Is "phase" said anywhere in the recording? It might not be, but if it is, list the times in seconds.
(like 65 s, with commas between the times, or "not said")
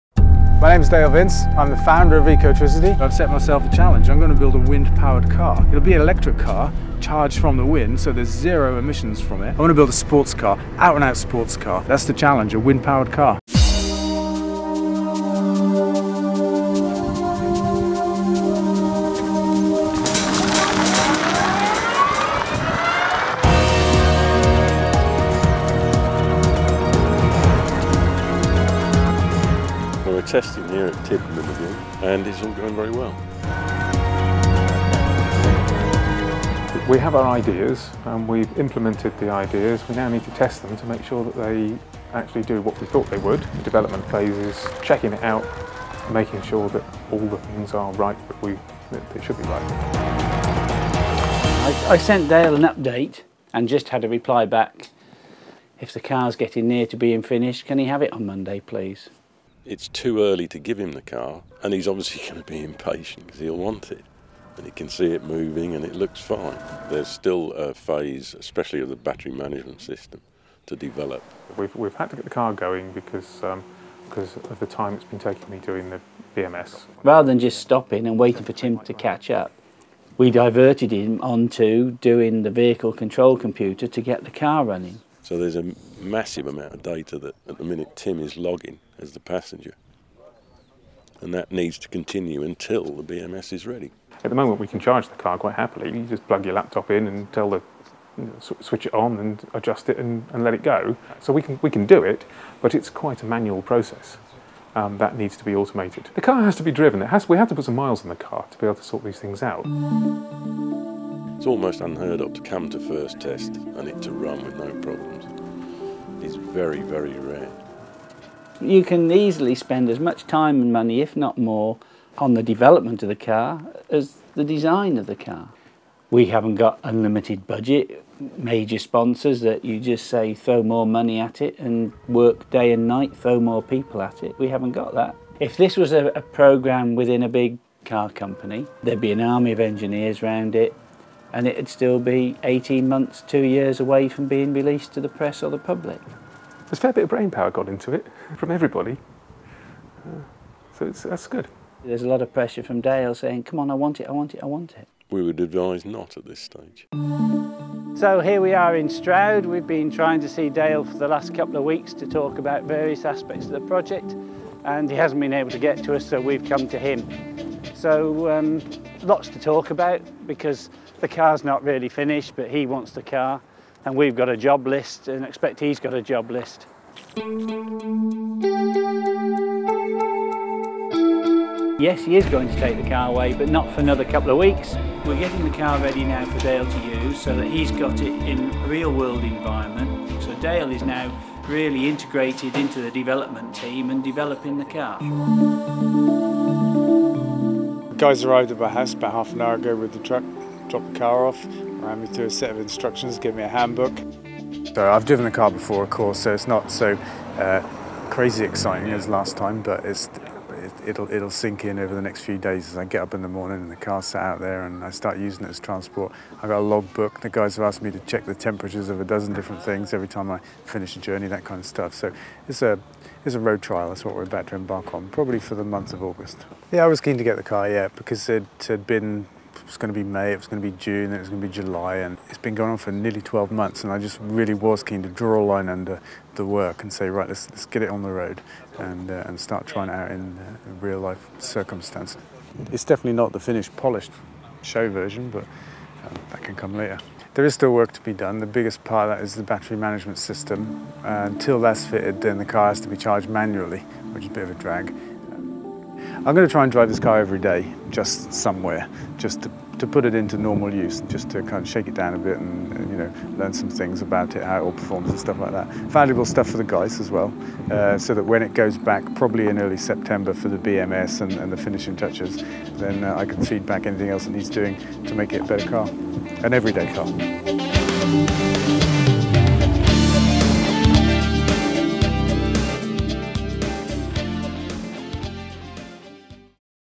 44 s, 67 s.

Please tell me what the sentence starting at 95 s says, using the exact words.
You just plug your laptop in and tell the you know, switch it on and adjust it and, and let it go.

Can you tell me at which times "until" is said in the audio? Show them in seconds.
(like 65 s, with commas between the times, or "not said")
92 s, 251 s.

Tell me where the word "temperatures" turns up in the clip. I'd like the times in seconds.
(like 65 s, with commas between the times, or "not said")
218 s.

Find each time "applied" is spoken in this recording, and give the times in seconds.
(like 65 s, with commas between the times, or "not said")
not said.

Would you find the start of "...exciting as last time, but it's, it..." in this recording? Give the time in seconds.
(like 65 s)
208 s.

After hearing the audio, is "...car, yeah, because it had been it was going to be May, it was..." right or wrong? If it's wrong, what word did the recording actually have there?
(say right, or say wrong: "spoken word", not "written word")
right.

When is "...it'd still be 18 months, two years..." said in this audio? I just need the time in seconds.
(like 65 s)
141 s.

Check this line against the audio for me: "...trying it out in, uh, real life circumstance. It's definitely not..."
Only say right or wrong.
right.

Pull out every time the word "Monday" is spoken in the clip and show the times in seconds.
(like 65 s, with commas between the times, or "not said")
58 s.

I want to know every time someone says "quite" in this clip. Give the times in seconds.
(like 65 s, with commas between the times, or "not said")
95 s, 102 s.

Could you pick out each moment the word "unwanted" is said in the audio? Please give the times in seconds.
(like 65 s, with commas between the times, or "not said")
not said.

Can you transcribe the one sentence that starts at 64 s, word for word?
And he can see it moving and it looks fine.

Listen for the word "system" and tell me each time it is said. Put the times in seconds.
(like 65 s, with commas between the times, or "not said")
69 s, 250 s.